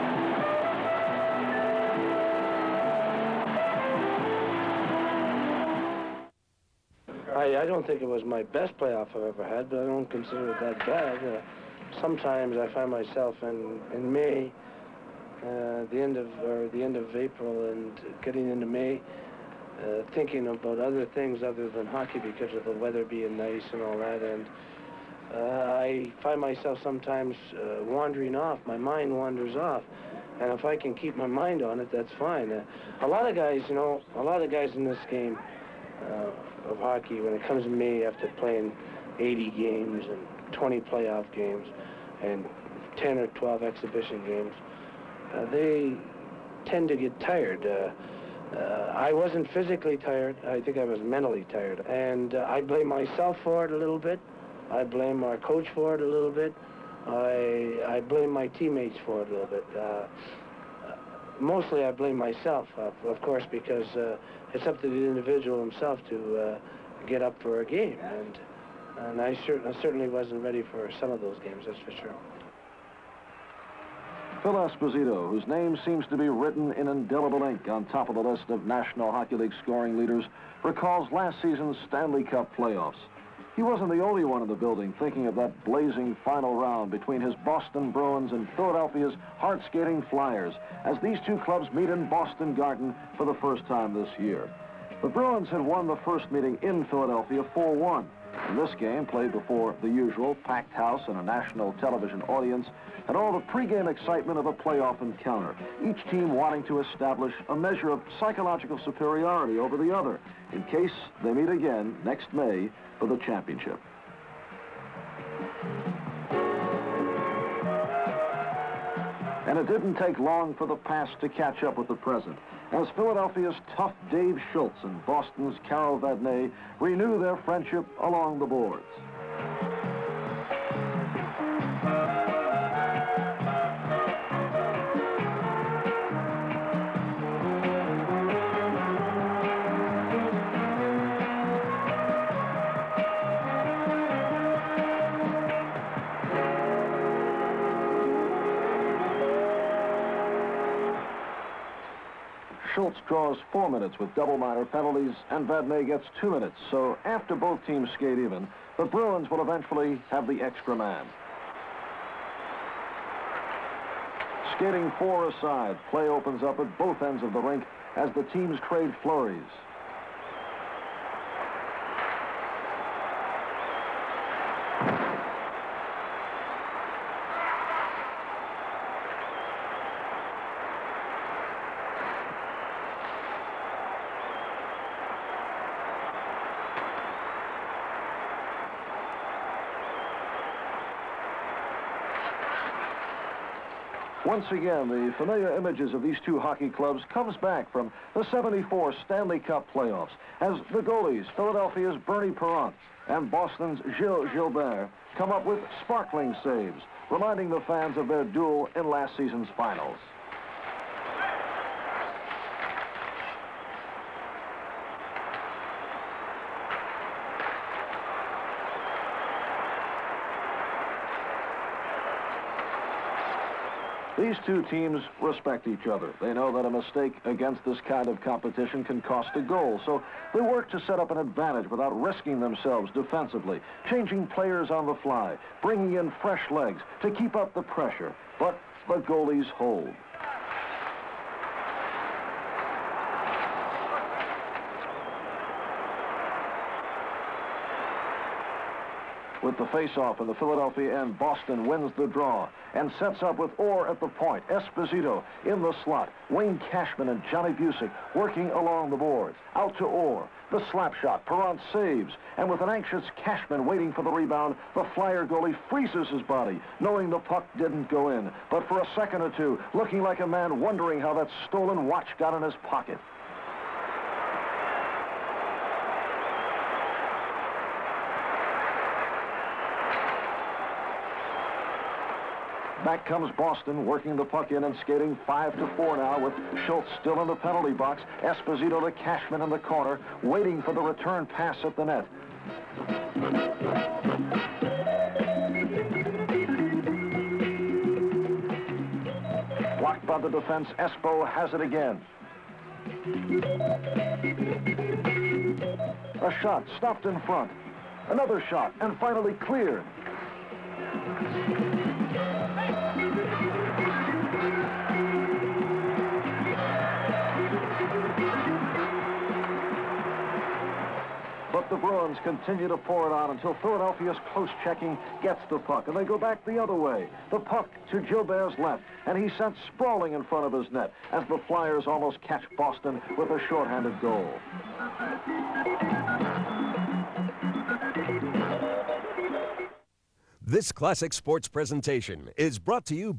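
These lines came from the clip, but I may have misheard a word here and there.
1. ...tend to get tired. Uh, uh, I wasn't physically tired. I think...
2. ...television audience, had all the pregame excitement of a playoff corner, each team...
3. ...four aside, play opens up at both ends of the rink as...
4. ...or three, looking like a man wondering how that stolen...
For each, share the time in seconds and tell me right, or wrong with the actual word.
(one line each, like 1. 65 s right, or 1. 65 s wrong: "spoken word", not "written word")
1. 46 s right
2. 101 s wrong: "encounter", not "corner"
3. 164 s right
4. 269 s wrong: "two", not "three".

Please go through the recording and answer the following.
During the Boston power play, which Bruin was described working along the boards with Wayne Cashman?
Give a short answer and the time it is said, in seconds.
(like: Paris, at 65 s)
Johnny Bucyk, at 257 s.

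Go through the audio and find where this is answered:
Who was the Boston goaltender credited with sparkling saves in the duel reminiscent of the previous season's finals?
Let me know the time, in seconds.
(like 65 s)
203 s.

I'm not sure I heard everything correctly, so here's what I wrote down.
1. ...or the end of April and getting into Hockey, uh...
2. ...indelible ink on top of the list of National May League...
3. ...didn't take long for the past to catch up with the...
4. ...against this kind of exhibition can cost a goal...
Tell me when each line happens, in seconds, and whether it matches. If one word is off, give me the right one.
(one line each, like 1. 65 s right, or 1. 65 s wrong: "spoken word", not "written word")
1. 16 s wrong: "May", not "Hockey"
2. 76 s wrong: "Hockey", not "May"
3. 119 s right
4. 227 s wrong: "competition", not "exhibition".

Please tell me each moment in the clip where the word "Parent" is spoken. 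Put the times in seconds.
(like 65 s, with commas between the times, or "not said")
202 s, 261 s.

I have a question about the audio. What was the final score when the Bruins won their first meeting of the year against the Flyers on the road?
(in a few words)
4-1.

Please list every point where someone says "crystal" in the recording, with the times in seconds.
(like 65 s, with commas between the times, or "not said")
not said.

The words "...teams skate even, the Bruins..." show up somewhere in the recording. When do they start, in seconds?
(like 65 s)
157 s.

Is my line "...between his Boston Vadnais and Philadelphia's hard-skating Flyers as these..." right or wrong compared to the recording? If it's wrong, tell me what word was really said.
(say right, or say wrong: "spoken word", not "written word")
wrong: "Bruins", not "Vadnais".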